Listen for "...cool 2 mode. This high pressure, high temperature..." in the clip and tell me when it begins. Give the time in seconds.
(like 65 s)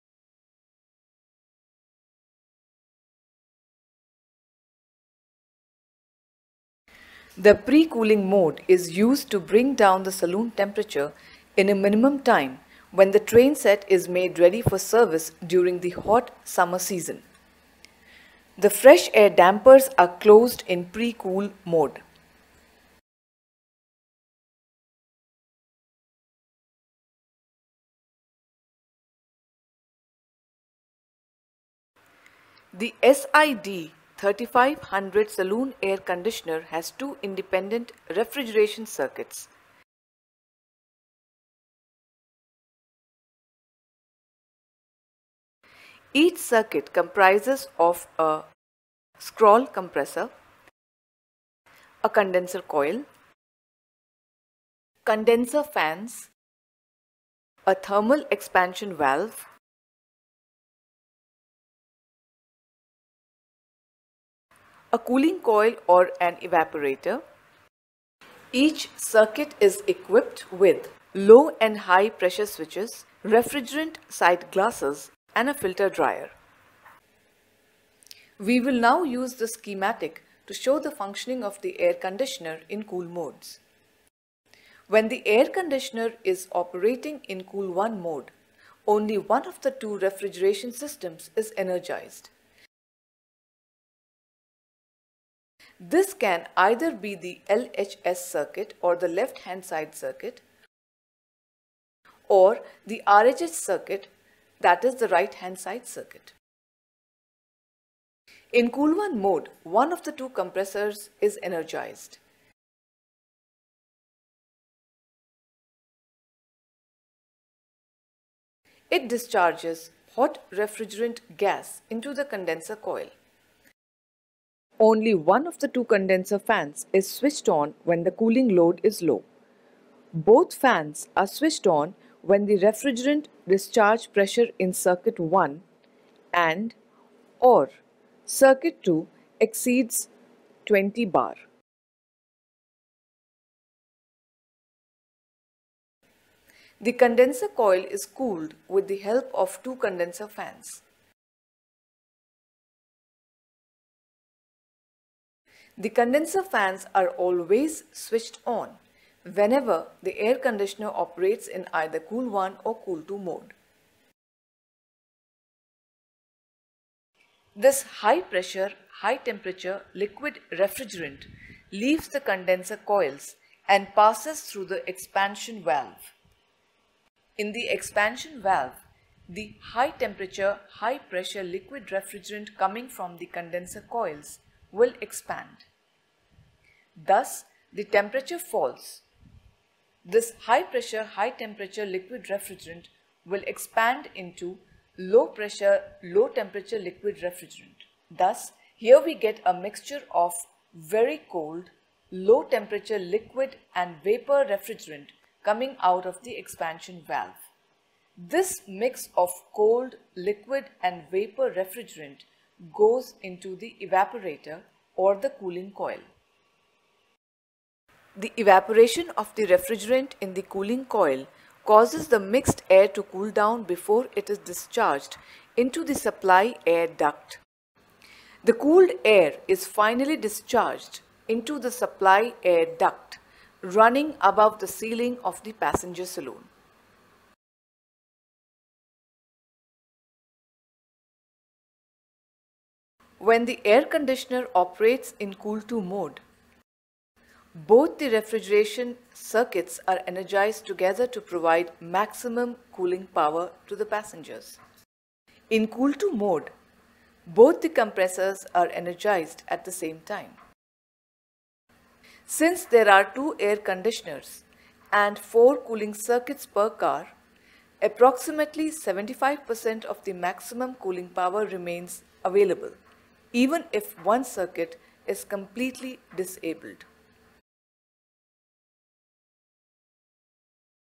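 162 s.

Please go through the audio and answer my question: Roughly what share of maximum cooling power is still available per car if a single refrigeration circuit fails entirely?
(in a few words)
75%.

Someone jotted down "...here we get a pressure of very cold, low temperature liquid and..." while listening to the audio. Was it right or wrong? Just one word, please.
wrong.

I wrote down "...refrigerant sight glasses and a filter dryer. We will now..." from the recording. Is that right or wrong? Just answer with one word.
right.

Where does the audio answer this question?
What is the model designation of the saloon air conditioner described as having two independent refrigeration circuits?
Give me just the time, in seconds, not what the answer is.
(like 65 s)
33 s.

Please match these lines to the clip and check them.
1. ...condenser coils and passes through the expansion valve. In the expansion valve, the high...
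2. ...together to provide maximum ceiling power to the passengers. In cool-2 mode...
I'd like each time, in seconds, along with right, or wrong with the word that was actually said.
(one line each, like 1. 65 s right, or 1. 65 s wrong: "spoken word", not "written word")
1. 172 s right
2. 250 s wrong: "cooling", not "ceiling".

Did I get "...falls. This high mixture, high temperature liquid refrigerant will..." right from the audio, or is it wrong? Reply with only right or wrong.
wrong.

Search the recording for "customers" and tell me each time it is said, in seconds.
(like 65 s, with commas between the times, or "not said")
not said.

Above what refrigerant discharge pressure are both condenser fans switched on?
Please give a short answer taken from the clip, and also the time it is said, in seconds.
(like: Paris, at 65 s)
20 bar, at 140 s.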